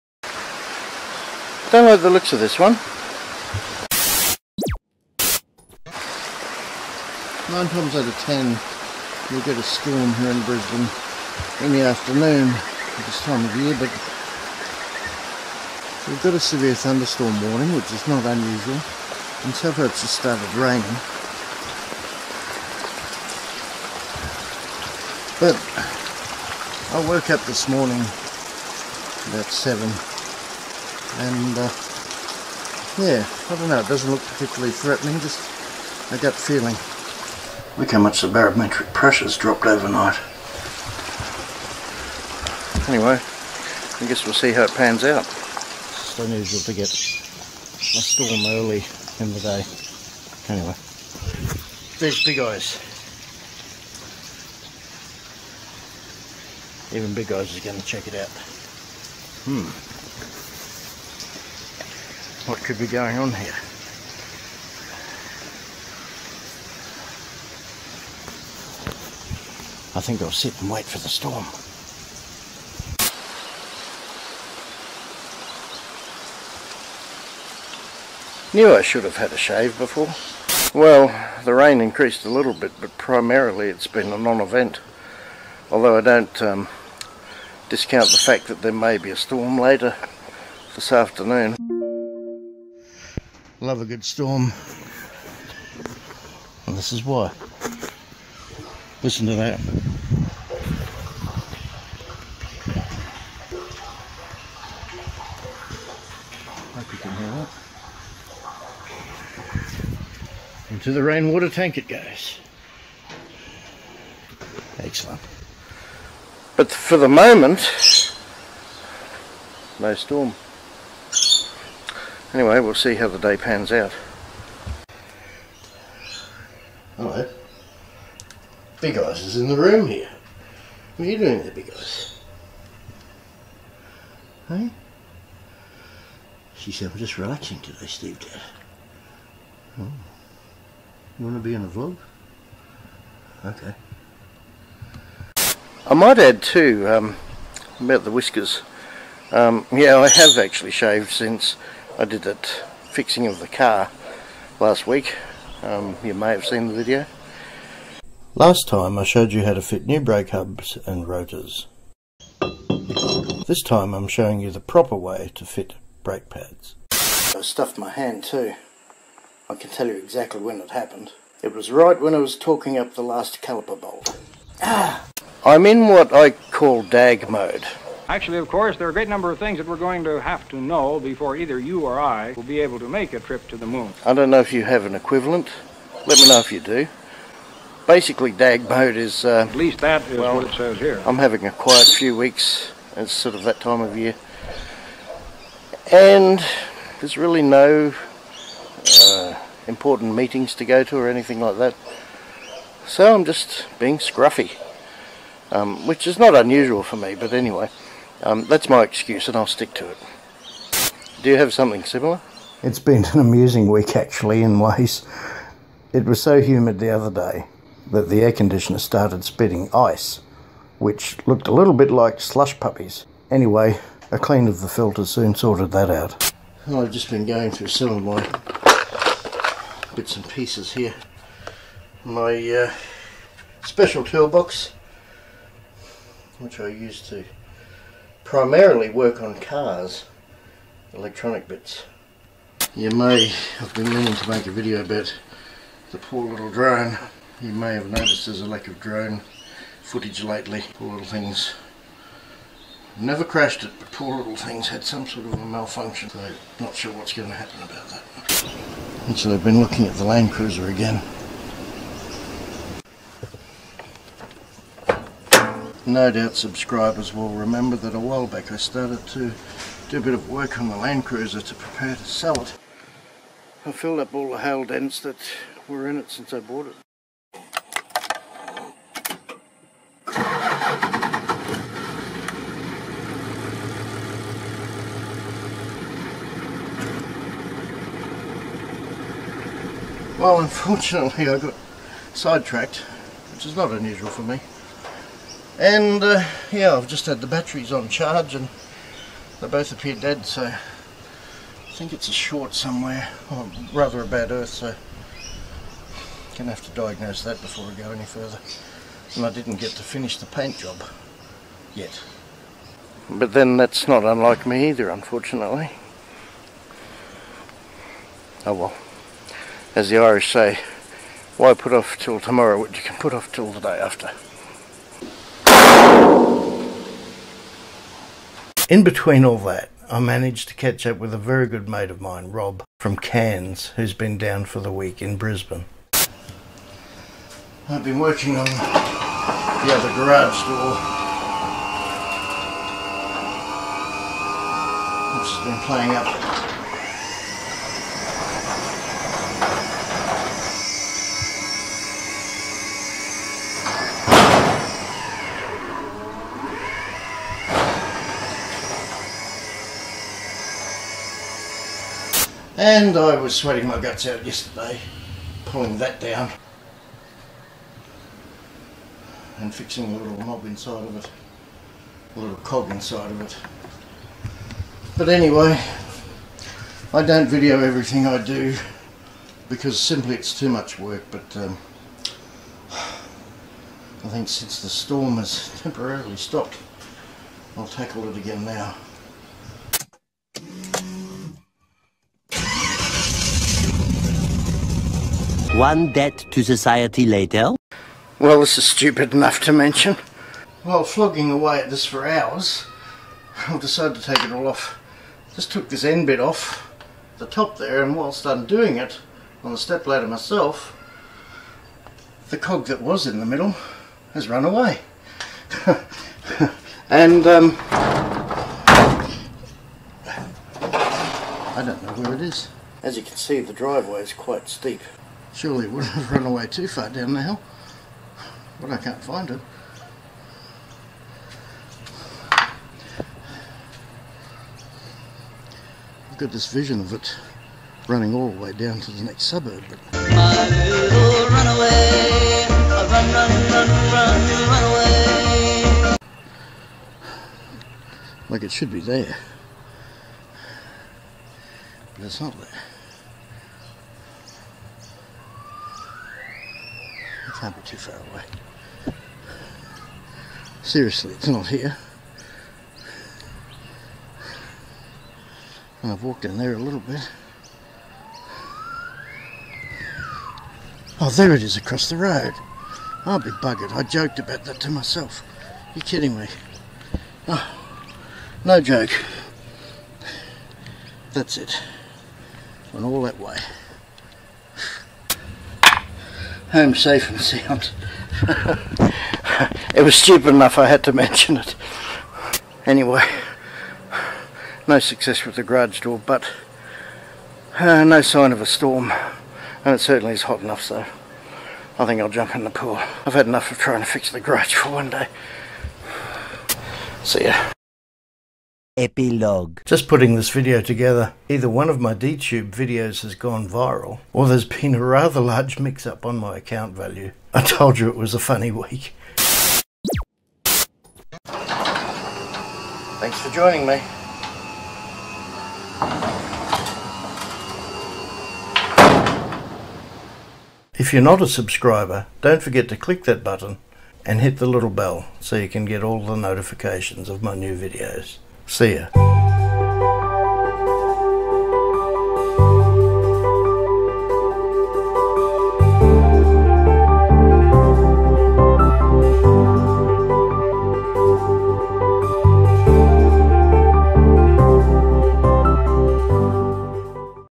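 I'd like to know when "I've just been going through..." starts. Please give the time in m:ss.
3:46.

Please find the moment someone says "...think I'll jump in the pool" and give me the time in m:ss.
8:21.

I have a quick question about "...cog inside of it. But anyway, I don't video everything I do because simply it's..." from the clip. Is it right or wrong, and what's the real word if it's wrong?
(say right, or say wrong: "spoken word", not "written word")
right.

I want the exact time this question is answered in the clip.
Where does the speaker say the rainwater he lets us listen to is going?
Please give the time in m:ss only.
1:50.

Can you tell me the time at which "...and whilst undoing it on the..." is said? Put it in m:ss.
6:47.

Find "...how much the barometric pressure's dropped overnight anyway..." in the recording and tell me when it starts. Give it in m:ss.
0:37.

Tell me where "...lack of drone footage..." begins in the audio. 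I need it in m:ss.
4:08.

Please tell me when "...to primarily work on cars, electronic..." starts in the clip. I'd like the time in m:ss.
3:57.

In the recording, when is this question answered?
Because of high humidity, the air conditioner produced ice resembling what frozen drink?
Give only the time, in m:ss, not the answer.
3:42.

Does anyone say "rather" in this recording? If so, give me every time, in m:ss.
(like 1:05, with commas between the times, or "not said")
5:03, 8:34.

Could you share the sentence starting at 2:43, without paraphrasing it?
This time I'm showing you the proper way to fit brake pads.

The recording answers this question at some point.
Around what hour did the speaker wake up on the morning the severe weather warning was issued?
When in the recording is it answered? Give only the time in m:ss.
0:29.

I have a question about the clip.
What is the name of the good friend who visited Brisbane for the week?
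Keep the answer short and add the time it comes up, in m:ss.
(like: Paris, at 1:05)
Rob, at 5:32.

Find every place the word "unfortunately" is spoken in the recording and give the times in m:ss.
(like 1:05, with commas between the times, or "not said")
4:50, 5:14.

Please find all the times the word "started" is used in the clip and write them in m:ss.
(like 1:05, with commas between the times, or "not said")
0:20, 3:38, 4:28.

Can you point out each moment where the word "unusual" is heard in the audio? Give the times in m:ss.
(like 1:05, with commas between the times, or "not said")
0:18, 0:46, 3:26, 4:53.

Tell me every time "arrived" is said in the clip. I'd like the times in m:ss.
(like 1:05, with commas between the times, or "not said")
not said.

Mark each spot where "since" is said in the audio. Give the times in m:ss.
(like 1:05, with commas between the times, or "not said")
2:31, 4:36, 6:24.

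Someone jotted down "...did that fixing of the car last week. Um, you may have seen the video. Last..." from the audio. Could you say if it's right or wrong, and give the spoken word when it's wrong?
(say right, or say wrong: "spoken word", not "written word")
right.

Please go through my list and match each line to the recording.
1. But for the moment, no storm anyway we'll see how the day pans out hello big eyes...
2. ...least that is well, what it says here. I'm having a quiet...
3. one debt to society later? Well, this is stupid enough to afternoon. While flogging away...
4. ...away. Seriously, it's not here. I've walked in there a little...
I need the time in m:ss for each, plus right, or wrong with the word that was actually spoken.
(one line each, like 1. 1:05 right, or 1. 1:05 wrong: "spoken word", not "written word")
1. 1:56 right
2. 3:09 right
3. 6:35 wrong: "mention", not "afternoon"
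4. 7:38 right.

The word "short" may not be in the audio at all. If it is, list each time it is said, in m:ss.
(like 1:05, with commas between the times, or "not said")
5:02.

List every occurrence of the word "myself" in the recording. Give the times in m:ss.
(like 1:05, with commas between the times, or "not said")
6:50, 7:54.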